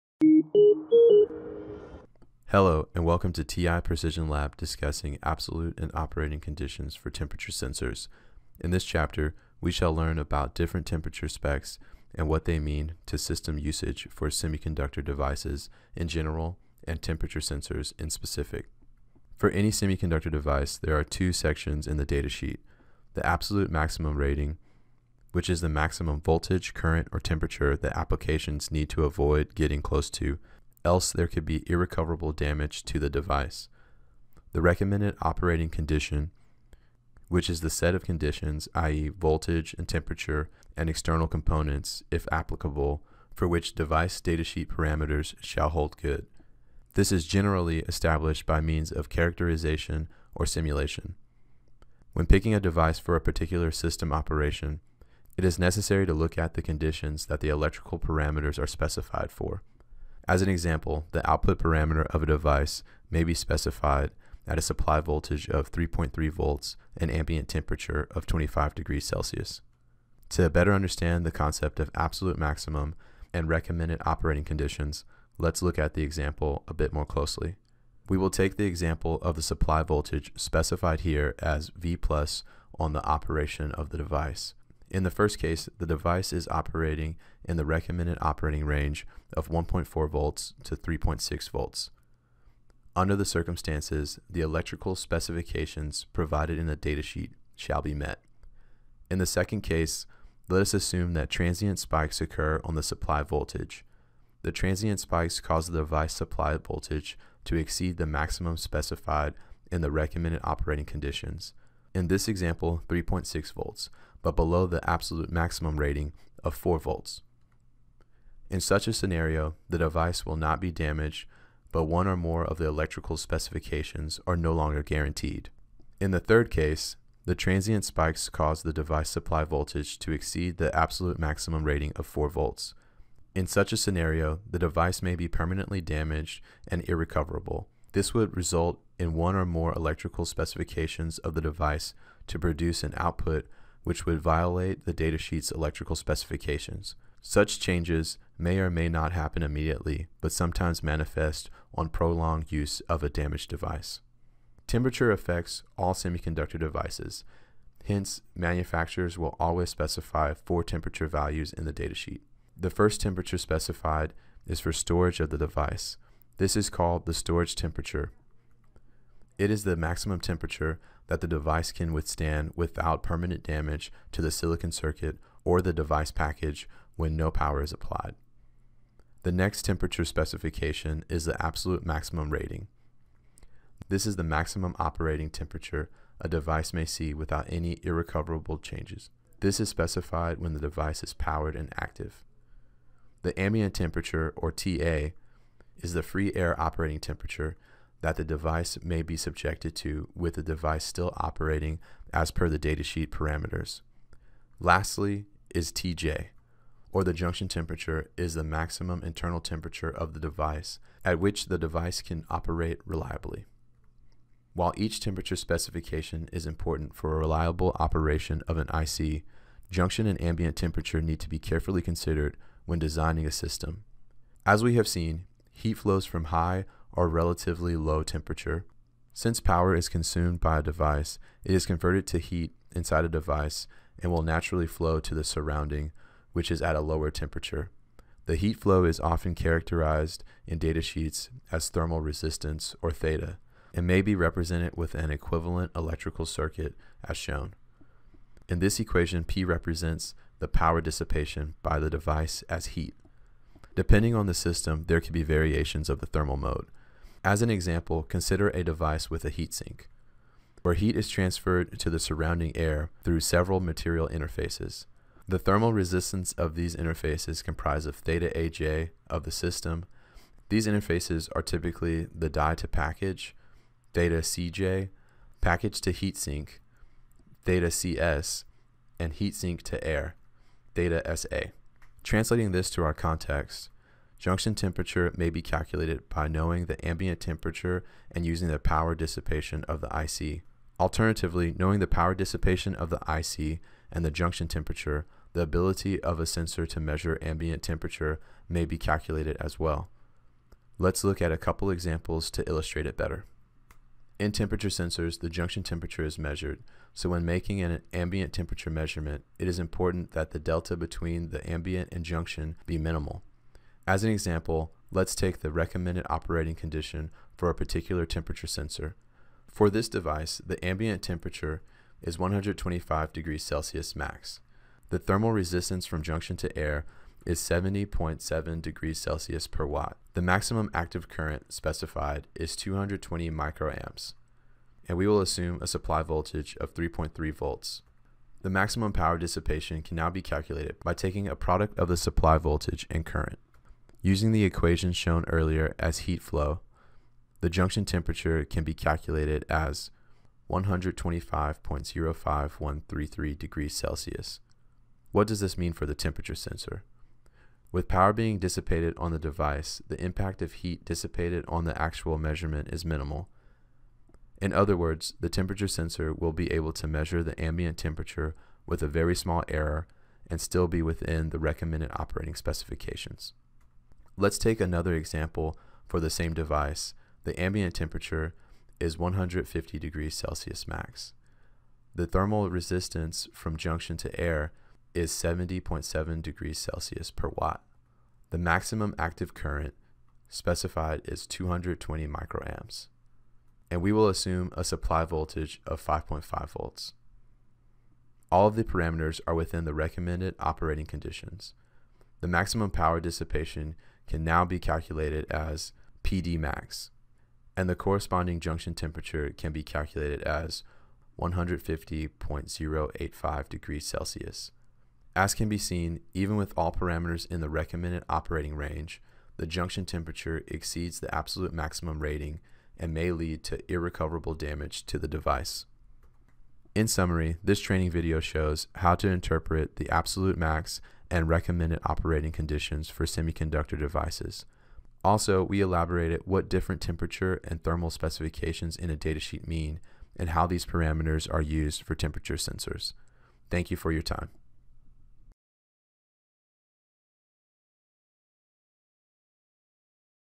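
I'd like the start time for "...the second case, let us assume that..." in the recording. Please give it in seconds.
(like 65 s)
99 s.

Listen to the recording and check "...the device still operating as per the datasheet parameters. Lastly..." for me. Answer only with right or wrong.
right.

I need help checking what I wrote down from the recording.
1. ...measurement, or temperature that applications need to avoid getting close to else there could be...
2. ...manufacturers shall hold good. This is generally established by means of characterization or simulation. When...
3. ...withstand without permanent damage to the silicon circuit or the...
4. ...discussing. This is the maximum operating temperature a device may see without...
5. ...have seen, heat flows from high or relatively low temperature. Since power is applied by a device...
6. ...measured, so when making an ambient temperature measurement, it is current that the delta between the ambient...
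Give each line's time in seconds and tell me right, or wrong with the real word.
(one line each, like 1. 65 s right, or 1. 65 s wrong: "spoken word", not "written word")
1. 26 s wrong: "current", not "measurement"
2. 44 s wrong: "parameters", not "manufacturers"
3. 171 s right
4. 182 s wrong: "rating", not "discussing"
5. 224 s wrong: "consumed", not "applied"
6. 306 s wrong: "important", not "current".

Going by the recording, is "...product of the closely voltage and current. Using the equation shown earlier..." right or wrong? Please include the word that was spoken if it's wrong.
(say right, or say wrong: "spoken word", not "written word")
wrong: "supply", not "closely".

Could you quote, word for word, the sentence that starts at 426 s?
In summary, this training video shows how to interpret the absolute max and recommended operating conditions for semiconductor devices.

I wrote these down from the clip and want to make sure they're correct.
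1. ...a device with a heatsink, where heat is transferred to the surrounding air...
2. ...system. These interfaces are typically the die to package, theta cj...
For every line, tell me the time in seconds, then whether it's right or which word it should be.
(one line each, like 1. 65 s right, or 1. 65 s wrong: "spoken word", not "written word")
1. 258 s right
2. 269 s right.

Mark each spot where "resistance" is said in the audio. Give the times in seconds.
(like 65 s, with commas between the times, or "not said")
242 s, 265 s, 325 s, 382 s.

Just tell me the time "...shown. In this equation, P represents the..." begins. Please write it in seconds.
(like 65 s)
247 s.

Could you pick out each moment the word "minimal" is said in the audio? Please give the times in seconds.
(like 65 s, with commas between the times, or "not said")
312 s, 362 s.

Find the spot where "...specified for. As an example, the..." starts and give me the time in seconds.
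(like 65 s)
58 s.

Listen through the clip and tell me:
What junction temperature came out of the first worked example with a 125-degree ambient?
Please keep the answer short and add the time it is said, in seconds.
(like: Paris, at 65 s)
125.05133 °C, at 350 s.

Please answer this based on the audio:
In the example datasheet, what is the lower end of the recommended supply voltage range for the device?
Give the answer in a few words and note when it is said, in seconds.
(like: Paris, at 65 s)
1.4 volts, at 89 s.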